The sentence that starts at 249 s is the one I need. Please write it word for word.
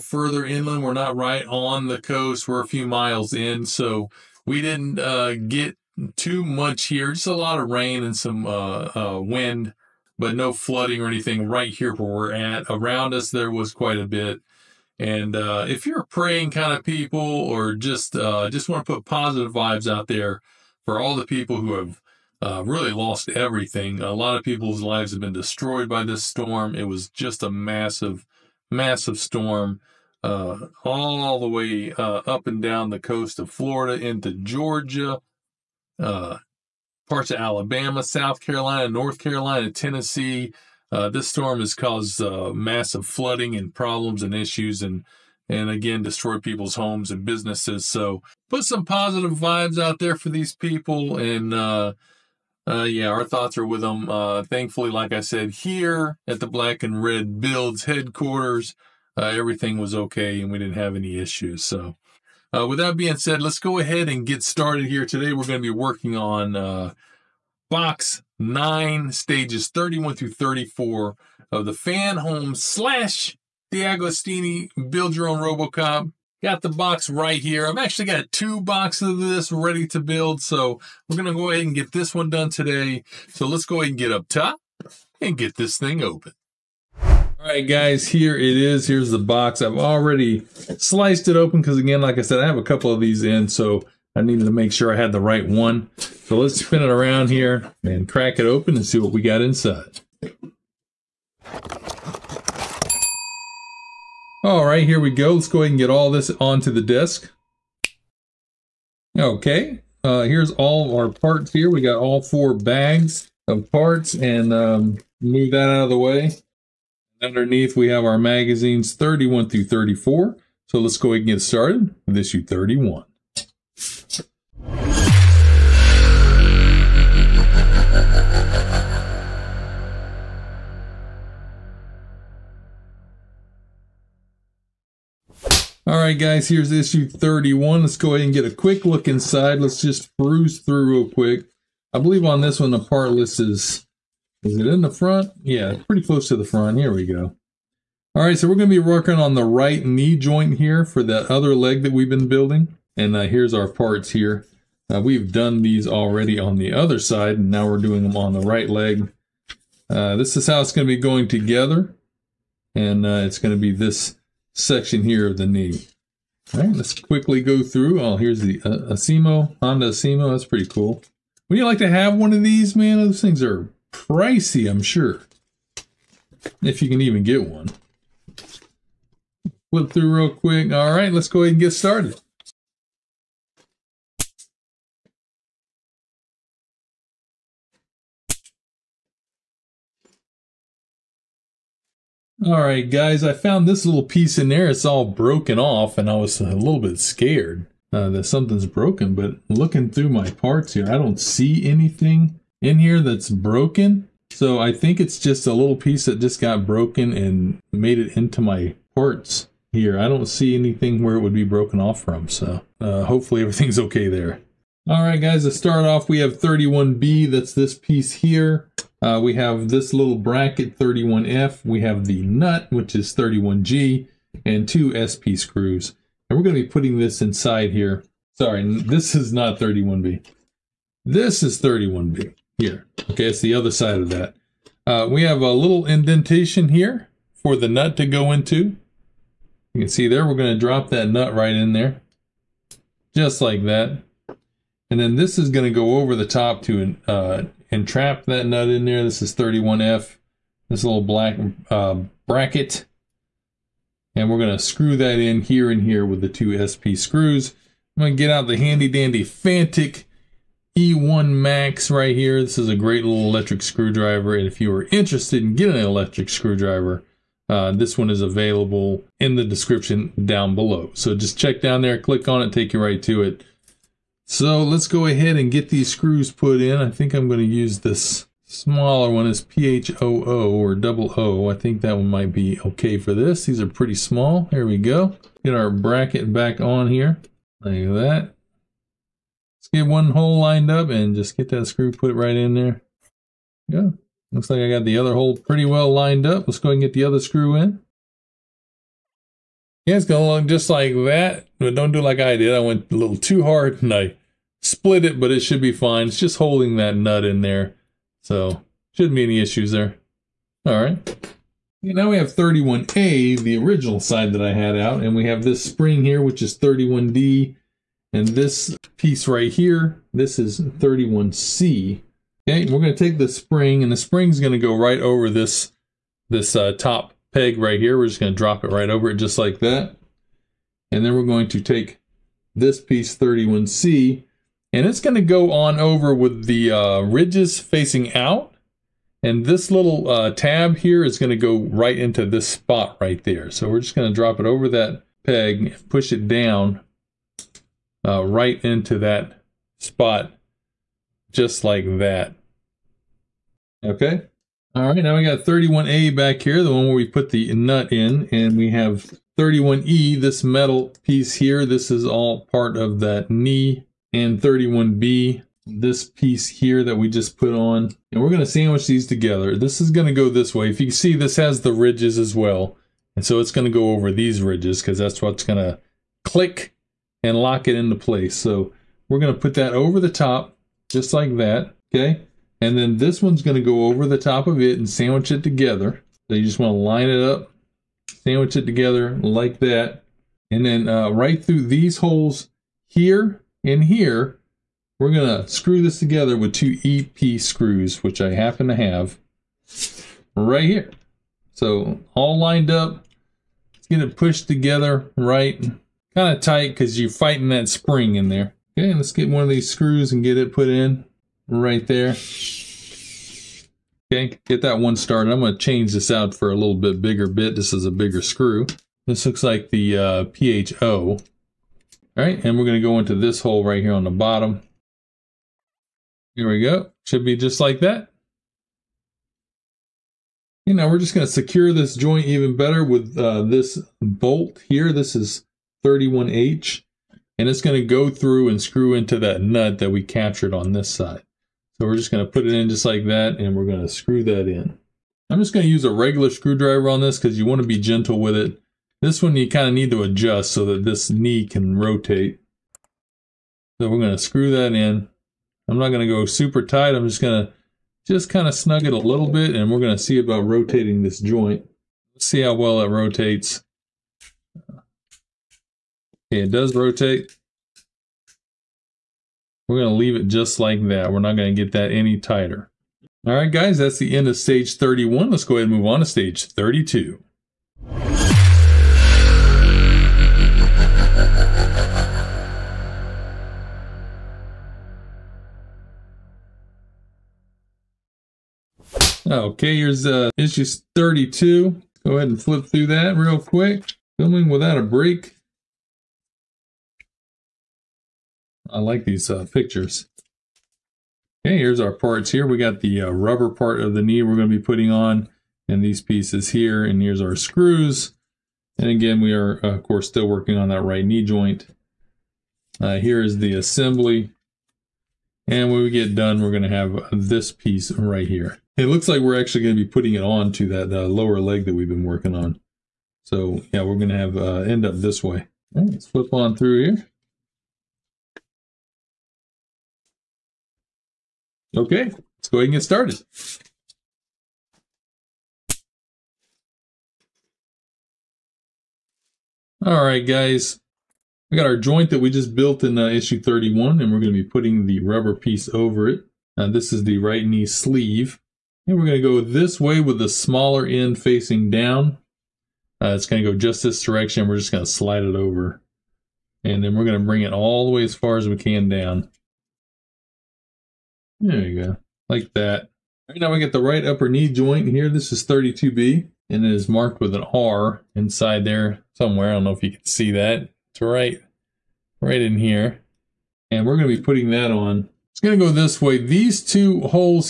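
This is 31F, this little black uh, bracket.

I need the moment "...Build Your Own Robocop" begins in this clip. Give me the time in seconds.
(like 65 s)
74 s.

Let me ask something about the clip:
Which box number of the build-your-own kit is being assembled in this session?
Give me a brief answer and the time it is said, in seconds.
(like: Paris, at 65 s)
9, at 67 s.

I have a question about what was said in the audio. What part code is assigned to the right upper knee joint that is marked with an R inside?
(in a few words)
32B.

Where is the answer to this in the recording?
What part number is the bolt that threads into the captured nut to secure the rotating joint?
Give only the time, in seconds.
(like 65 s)
435 s.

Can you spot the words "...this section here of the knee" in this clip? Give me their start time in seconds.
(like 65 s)
163 s.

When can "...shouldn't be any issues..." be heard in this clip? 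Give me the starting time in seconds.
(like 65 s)
308 s.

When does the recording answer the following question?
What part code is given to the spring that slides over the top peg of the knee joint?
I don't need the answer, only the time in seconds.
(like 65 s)
316 s.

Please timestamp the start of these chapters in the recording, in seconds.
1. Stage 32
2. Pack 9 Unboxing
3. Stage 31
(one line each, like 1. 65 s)
1. 472 s
2. 61 s
3. 120 s.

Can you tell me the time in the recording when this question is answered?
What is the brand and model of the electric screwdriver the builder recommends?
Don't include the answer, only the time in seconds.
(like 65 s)
259 s.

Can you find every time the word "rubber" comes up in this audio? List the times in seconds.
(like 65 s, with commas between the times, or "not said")
503 s, 545 s.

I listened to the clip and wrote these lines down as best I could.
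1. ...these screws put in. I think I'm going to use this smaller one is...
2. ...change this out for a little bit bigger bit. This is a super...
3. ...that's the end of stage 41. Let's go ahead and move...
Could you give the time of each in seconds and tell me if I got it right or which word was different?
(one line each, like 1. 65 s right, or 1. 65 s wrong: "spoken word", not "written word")
1. 275 s right
2. 415 s wrong: "bigger", not "super"
3. 473 s wrong: "31", not "41".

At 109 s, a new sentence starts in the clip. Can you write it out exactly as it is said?
Okay, uh, here's all our parts here.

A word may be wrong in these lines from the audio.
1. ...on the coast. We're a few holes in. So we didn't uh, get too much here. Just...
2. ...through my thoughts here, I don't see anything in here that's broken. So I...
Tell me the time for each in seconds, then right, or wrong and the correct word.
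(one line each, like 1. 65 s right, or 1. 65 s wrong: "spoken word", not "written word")
1. 1 s wrong: "miles", not "holes"
2. 199 s wrong: "parts", not "thoughts".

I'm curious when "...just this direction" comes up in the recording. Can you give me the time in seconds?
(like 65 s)
553 s.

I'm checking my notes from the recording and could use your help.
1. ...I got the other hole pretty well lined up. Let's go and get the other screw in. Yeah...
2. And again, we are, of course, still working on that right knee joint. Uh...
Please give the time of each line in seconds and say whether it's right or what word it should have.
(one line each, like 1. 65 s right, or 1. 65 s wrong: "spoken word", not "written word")
1. 294 s right
2. 508 s right.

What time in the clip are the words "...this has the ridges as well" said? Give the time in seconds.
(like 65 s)
371 s.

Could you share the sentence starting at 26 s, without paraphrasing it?
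It was just a massive, massive storm.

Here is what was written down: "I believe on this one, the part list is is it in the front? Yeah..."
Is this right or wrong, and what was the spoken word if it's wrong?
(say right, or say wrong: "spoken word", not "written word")
right.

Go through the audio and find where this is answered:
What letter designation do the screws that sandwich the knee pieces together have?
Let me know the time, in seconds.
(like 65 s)
396 s.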